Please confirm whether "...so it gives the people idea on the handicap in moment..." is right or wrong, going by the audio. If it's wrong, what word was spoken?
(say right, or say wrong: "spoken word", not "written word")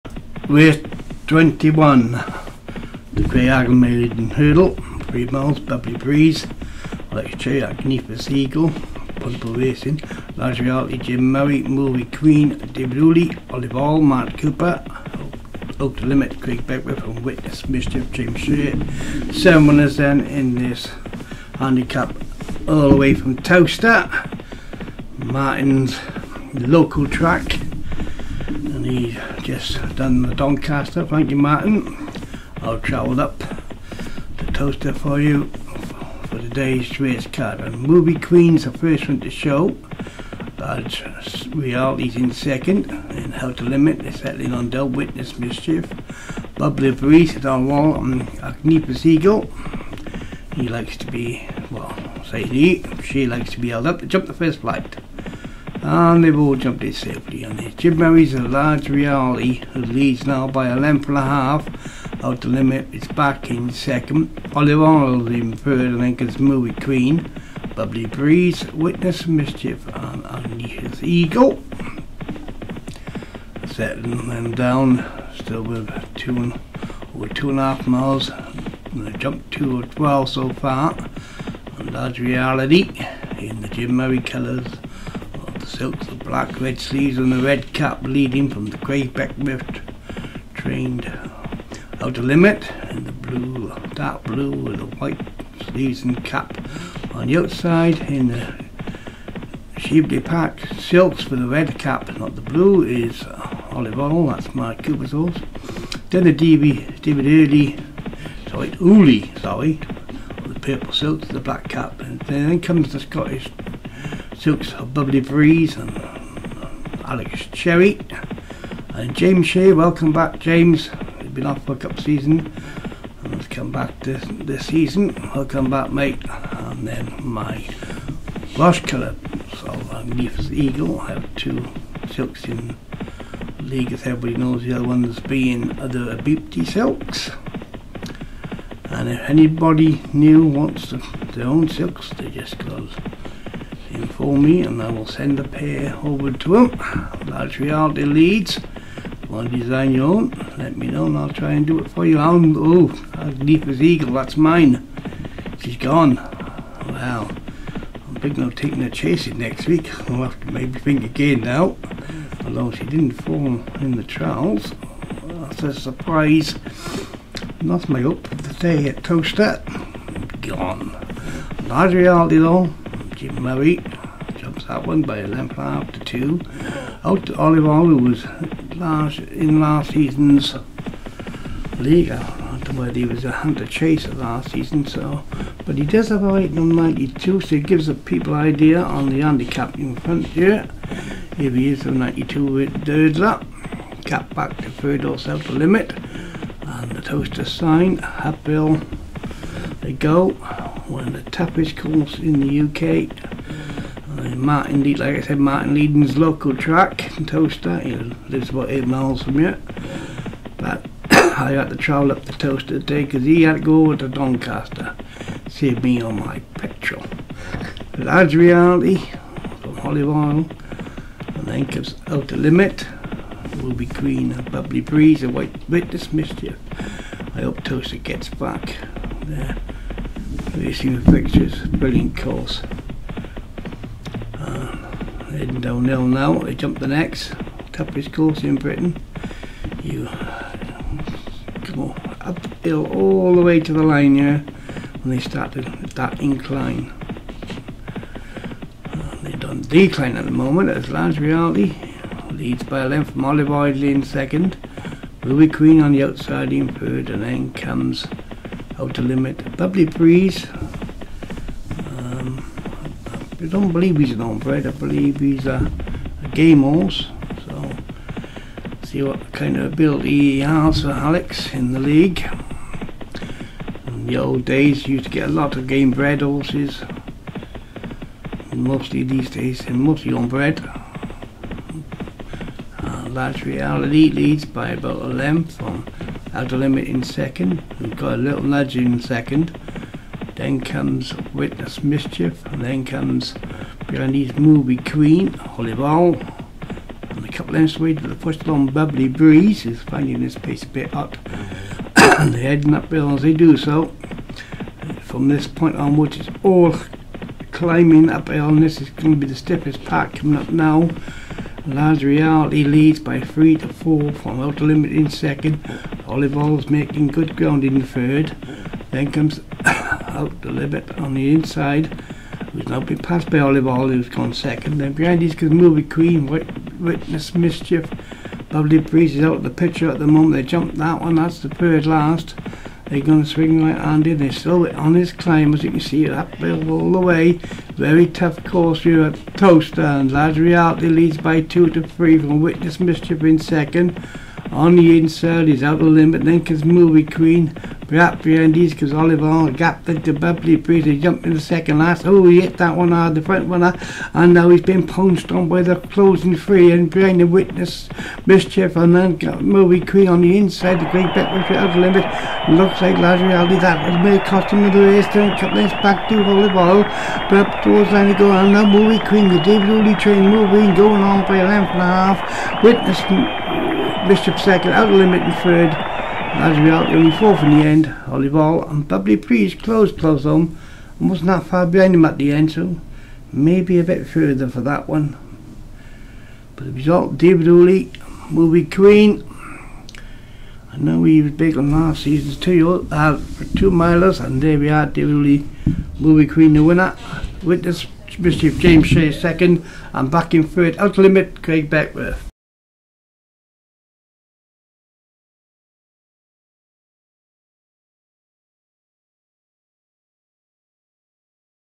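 wrong: "front", not "moment".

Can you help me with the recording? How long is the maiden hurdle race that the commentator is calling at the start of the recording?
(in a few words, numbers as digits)
3 miles.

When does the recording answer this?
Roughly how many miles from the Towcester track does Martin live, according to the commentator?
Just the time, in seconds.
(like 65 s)
208 s.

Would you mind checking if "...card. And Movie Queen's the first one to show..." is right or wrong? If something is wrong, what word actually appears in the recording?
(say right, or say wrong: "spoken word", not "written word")
right.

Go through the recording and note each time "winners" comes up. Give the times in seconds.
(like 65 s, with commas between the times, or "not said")
19 s, 396 s.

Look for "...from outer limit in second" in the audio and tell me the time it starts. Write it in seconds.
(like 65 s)
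314 s.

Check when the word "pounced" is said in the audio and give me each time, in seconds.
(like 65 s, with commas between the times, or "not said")
354 s.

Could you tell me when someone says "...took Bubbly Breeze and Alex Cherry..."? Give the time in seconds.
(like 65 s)
114 s.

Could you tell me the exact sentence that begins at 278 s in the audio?
Mostly these days, and mostly on bread uh, large reality leads by about a length on Outer Limit in second.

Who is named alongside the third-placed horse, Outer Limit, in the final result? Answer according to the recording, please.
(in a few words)
Craig Beckworth.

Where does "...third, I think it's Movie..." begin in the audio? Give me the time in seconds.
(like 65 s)
65 s.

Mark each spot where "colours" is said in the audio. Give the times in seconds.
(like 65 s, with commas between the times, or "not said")
84 s, 128 s.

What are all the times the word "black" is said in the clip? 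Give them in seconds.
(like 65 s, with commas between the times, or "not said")
86 s, 111 s.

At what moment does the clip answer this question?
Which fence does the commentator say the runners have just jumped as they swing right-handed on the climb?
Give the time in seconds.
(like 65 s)
331 s.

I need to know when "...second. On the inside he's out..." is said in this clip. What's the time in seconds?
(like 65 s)
343 s.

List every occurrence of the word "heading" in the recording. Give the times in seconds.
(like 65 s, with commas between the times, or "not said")
235 s, 302 s.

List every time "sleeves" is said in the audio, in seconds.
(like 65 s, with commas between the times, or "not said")
86 s, 95 s.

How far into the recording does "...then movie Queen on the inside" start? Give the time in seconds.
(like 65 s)
358 s.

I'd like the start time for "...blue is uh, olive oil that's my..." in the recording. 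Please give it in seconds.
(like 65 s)
102 s.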